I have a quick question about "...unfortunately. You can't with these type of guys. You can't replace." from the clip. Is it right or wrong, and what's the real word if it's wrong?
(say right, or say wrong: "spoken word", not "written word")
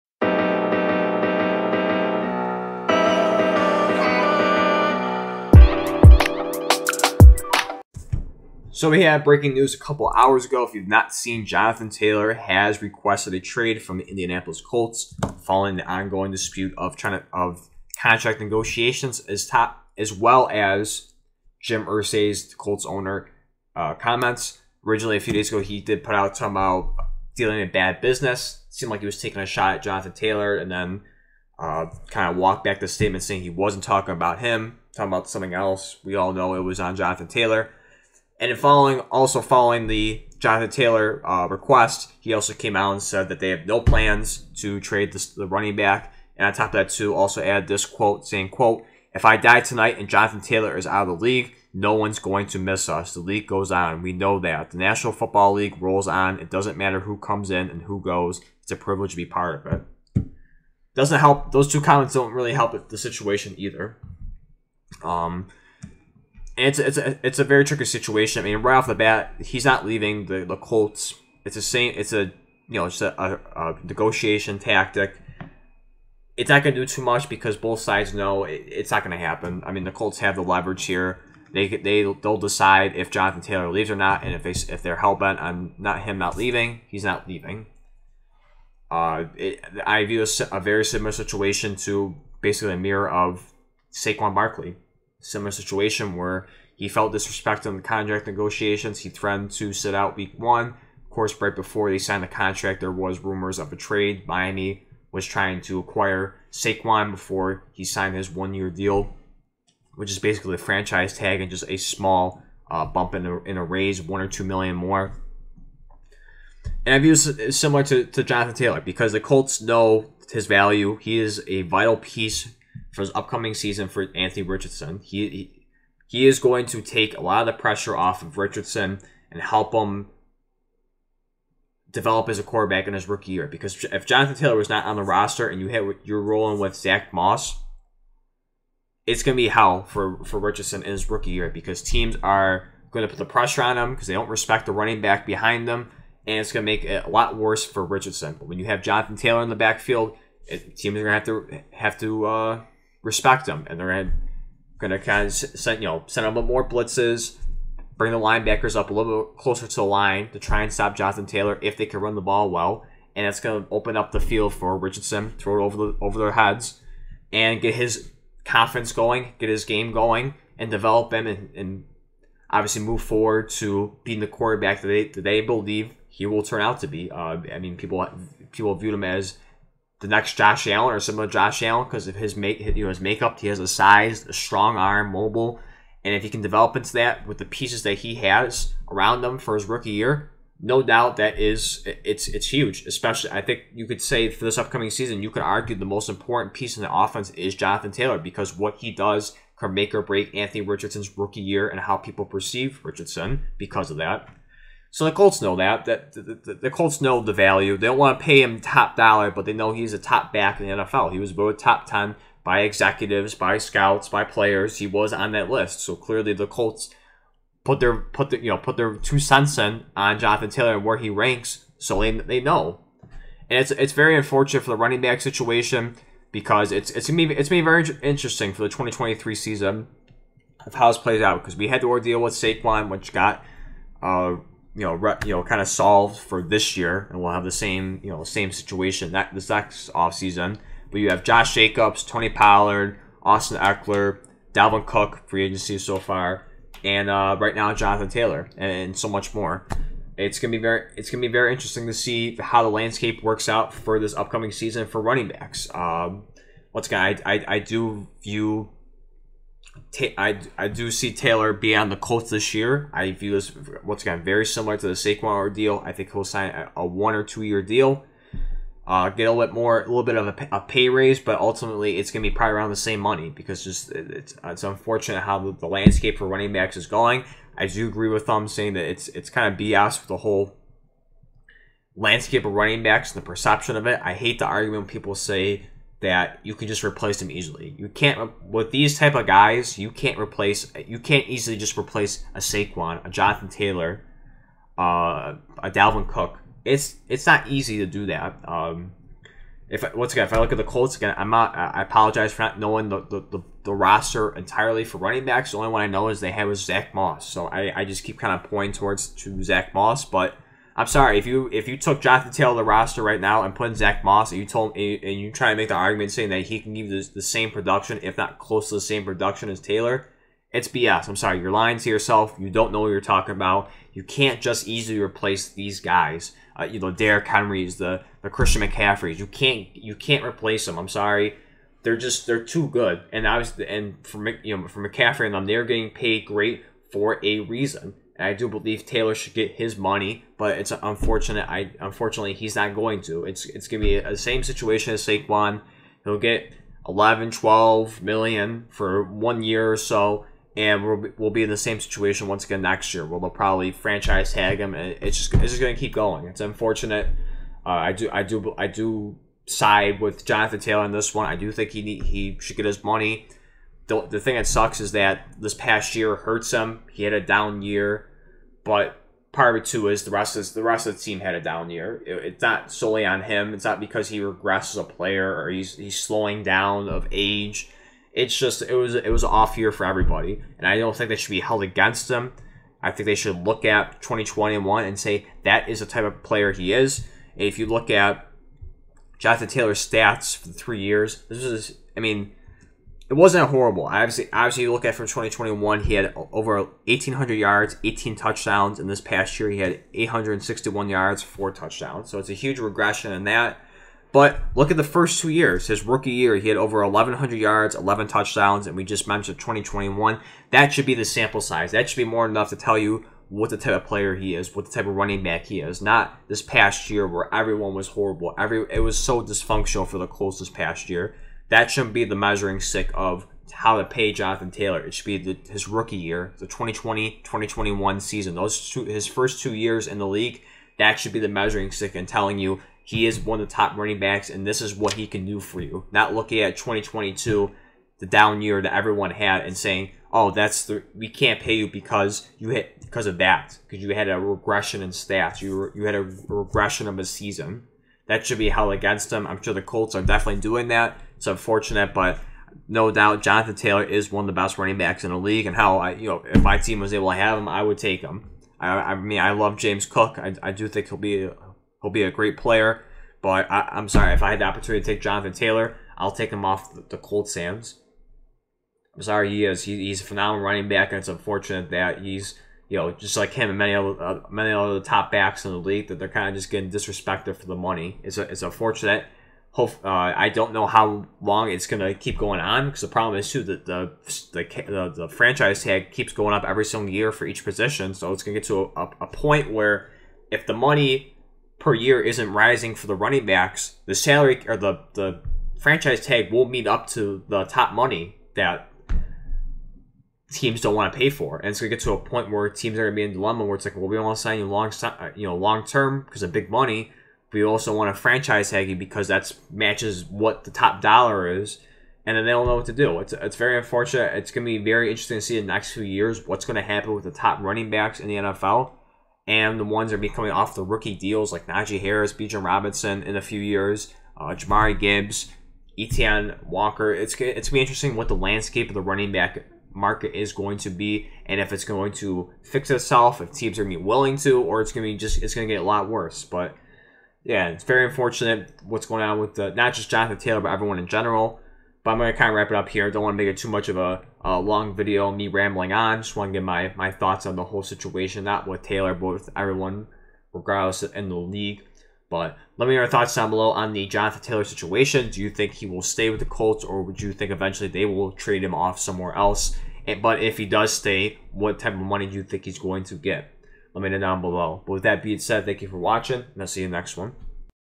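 wrong: "easily", not "unfortunately".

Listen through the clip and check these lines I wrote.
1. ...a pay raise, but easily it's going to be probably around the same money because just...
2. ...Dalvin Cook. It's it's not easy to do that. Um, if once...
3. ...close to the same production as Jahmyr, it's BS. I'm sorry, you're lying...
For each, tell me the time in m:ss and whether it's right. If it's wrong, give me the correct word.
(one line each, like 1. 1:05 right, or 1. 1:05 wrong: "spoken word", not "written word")
1. 4:30 wrong: "ultimately", not "easily"
2. 4:55 right
3. 5:18 wrong: "Taylor", not "Jahmyr".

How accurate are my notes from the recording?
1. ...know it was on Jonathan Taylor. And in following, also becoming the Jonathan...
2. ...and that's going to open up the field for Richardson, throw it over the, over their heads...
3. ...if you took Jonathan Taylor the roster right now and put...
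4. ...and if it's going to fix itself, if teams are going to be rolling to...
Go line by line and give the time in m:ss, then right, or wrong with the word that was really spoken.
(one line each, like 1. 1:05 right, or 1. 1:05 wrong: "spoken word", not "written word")
1. 0:36 wrong: "following", not "becoming"
2. 2:43 right
3. 5:11 right
4. 8:51 wrong: "willing", not "rolling".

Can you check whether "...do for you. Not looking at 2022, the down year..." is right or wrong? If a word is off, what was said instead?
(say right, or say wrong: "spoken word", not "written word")
right.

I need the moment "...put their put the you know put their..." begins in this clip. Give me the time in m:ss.
3:37.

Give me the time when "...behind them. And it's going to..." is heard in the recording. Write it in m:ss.
2:25.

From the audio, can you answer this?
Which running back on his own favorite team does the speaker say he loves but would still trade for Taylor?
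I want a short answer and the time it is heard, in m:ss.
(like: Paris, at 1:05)
James Cook, at 7:39.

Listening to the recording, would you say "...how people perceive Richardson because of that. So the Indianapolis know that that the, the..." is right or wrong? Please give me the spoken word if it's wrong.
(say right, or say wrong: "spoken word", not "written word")
wrong: "Colts", not "Indianapolis".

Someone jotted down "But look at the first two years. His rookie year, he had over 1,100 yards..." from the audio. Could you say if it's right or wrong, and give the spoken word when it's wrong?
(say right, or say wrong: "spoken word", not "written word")
right.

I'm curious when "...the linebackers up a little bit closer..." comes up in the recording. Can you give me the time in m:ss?
2:38.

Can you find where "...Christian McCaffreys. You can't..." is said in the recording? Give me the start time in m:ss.
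5:28.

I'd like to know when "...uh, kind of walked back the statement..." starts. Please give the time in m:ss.
0:31.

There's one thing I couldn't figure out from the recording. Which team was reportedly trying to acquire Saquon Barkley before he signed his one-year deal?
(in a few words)
Miami.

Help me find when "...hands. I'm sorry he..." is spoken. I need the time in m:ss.
7:47.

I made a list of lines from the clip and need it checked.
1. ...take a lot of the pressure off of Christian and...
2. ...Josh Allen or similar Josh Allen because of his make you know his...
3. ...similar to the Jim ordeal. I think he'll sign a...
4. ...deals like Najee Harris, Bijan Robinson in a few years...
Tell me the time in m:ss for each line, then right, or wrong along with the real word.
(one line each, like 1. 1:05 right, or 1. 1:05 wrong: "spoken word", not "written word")
1. 2:06 wrong: "Richardson", not "Christian"
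2. 3:00 right
3. 4:24 wrong: "Saquon", not "Jim"
4. 8:40 right.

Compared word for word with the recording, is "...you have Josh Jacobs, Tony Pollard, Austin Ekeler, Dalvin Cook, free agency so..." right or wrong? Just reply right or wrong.
right.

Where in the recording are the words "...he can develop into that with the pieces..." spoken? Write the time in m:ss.
3:06.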